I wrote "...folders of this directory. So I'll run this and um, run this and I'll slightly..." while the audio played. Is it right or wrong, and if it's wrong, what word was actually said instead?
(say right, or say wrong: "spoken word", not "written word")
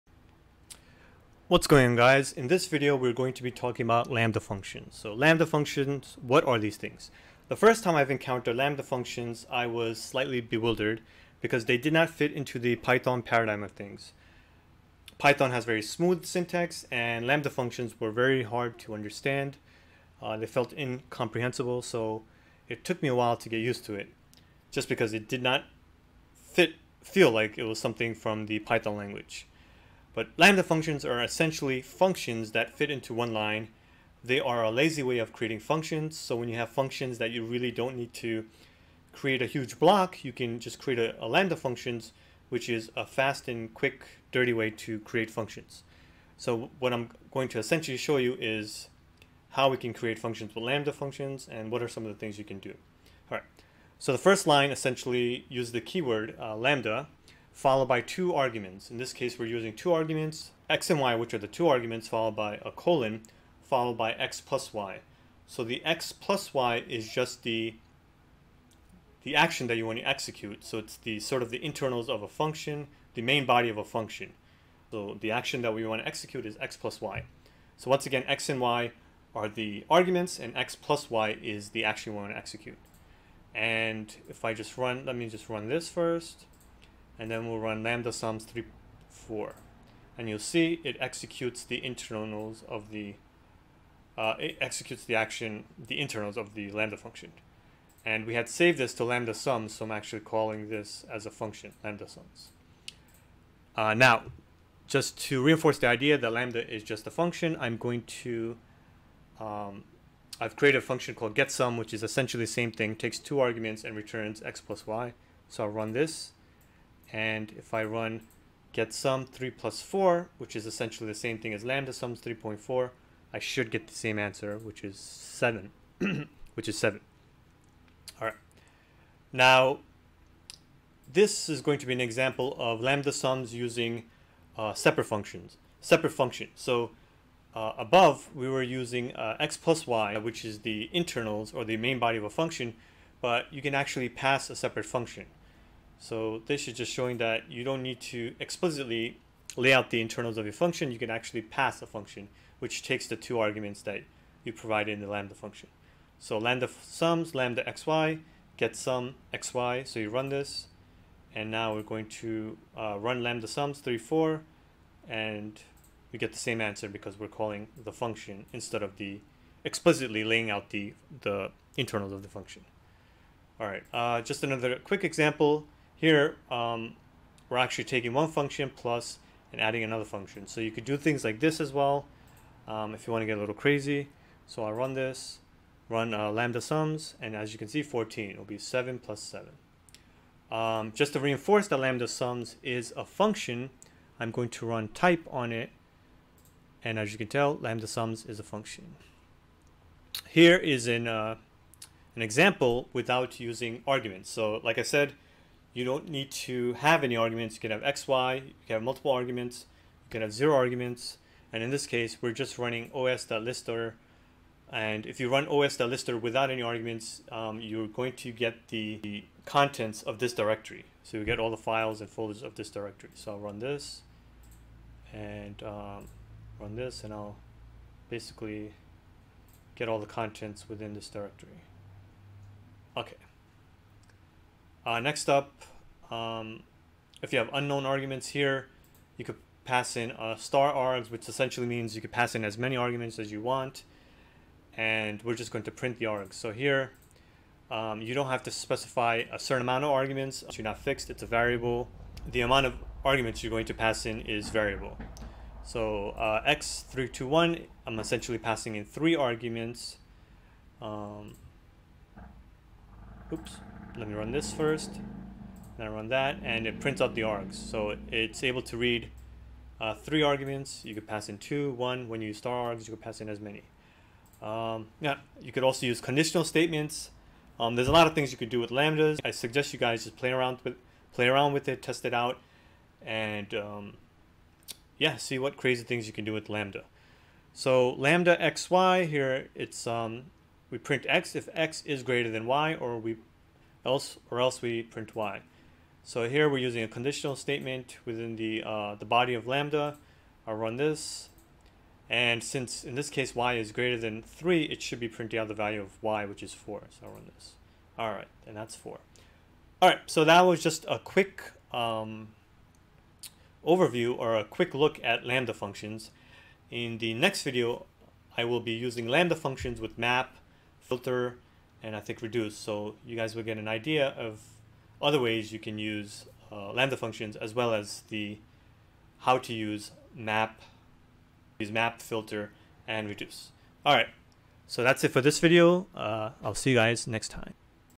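wrong: "basically", not "slightly".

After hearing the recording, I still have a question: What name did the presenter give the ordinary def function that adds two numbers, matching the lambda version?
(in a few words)
getSum.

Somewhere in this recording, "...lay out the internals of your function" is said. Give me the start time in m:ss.
2:29.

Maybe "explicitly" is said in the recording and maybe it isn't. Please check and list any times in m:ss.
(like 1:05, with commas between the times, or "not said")
2:28, 2:49.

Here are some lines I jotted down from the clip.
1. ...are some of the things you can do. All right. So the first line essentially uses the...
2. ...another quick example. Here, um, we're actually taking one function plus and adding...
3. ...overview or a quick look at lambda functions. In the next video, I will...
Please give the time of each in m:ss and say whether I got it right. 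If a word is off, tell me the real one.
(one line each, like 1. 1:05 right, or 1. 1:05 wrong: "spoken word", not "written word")
1. 0:51 right
2. 2:54 right
3. 5:13 right.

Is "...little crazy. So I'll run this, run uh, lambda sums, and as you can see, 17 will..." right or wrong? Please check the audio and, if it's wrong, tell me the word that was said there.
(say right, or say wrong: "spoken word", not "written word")
wrong: "14", not "17".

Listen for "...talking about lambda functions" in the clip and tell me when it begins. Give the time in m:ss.
0:03.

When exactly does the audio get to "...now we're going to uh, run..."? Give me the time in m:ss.
2:41.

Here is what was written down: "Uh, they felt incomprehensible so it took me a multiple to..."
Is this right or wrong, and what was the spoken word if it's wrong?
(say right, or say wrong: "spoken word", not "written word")
wrong: "while", not "multiple".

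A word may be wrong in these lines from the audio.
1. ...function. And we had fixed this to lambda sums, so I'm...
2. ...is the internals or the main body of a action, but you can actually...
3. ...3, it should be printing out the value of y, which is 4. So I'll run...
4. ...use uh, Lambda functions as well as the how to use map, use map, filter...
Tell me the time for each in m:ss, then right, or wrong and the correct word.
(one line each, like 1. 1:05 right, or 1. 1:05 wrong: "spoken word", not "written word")
1. 1:36 wrong: "saved", not "fixed"
2. 2:20 wrong: "function", not "action"
3. 5:04 right
4. 5:25 right.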